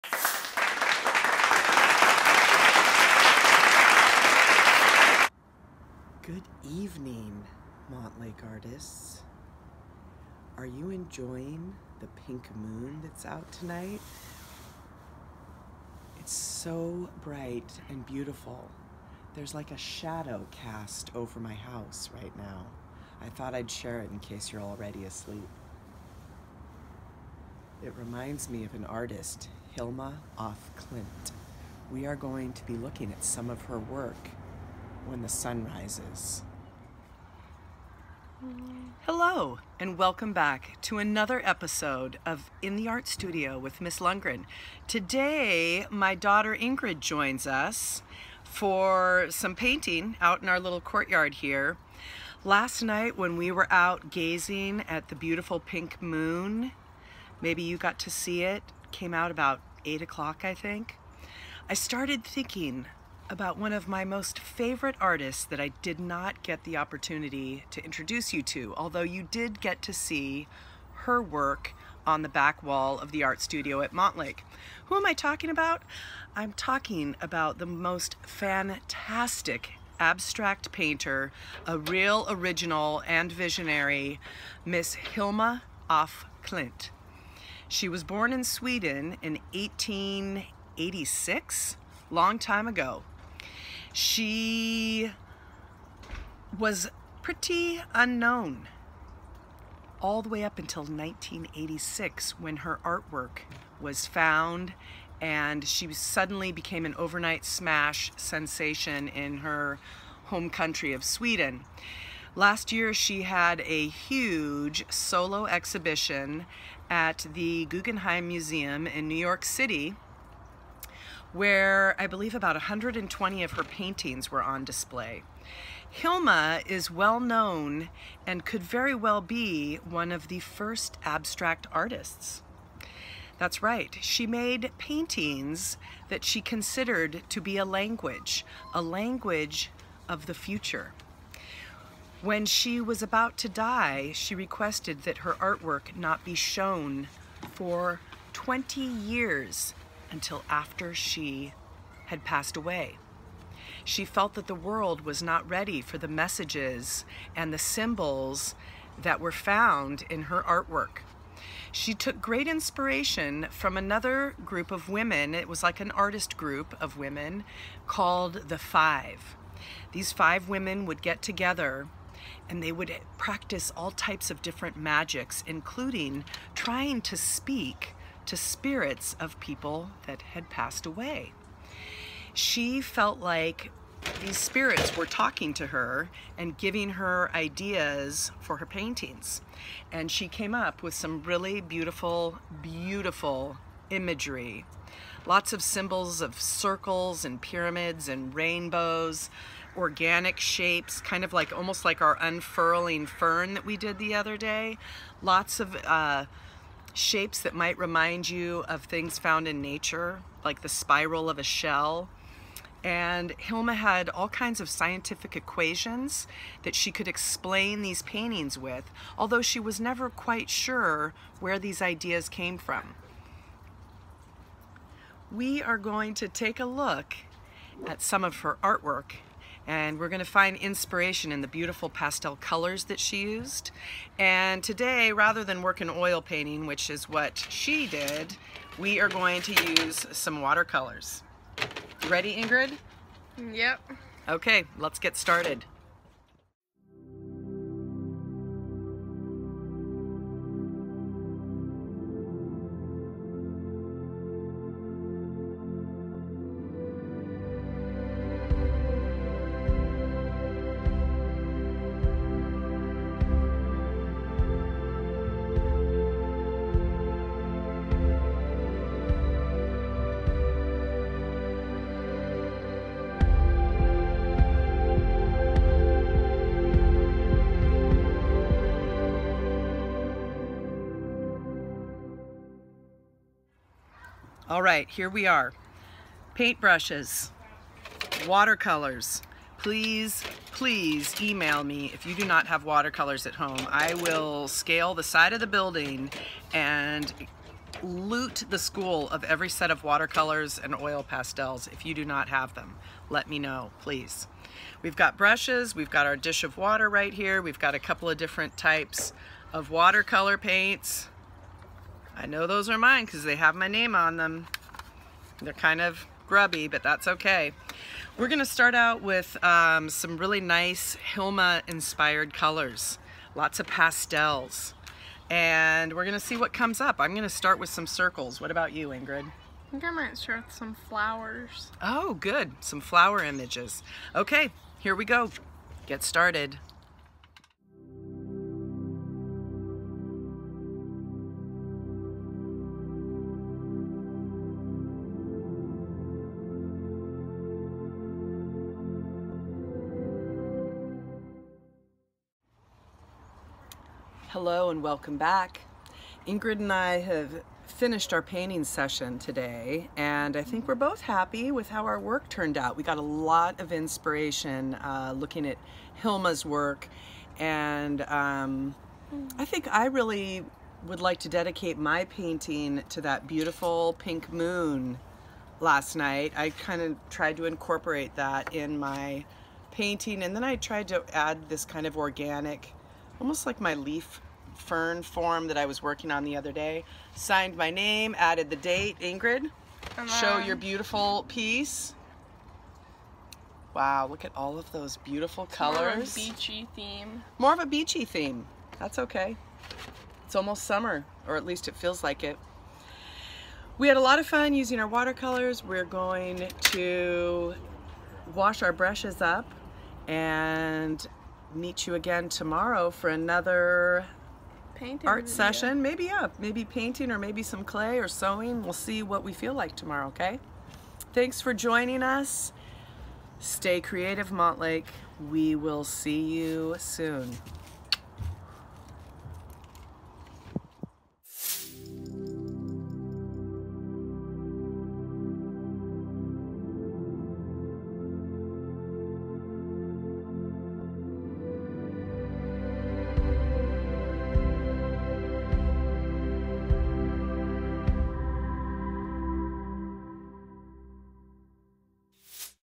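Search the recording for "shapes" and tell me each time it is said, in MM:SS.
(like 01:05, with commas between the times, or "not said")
03:20, 03:26.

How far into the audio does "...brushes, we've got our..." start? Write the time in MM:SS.
05:05.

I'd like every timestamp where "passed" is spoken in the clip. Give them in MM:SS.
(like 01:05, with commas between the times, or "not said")
02:32, 03:00.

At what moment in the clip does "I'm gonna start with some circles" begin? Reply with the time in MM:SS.
05:26.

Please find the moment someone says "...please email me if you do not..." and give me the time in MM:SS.
04:50.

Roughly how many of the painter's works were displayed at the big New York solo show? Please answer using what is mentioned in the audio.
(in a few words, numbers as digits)
120.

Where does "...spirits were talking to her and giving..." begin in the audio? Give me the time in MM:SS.
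03:04.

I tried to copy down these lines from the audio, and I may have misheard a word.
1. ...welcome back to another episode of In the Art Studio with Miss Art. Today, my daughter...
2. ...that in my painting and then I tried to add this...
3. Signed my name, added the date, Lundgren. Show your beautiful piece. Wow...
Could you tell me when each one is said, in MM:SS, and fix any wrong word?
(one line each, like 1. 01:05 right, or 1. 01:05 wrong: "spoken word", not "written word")
1. 00:39 wrong: "Lundgren", not "Art"
2. 06:18 right
3. 06:27 wrong: "Ingrid", not "Lundgren".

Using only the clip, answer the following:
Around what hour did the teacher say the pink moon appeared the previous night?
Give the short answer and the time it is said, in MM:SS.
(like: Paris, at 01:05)
8 o'clock, at 00:59.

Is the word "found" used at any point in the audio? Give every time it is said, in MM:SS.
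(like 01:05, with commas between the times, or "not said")
01:44, 02:39, 03:29.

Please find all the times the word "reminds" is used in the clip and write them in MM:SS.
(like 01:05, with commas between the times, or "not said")
00:27, 03:27.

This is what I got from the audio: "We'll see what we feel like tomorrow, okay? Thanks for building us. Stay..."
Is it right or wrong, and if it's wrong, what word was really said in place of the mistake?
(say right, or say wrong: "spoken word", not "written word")
wrong: "joining", not "building".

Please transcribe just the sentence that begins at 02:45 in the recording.
It was like an artist group of women called the Five.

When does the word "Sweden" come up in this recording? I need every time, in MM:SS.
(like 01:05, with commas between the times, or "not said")
01:28, 01:51.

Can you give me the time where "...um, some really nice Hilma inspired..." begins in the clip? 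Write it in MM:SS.
05:19.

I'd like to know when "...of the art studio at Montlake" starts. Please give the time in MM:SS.
01:12.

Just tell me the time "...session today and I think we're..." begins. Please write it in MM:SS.
05:58.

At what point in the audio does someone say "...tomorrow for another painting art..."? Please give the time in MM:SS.
06:52.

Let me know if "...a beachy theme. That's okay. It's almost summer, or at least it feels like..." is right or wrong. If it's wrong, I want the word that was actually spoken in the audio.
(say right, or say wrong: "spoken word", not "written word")
right.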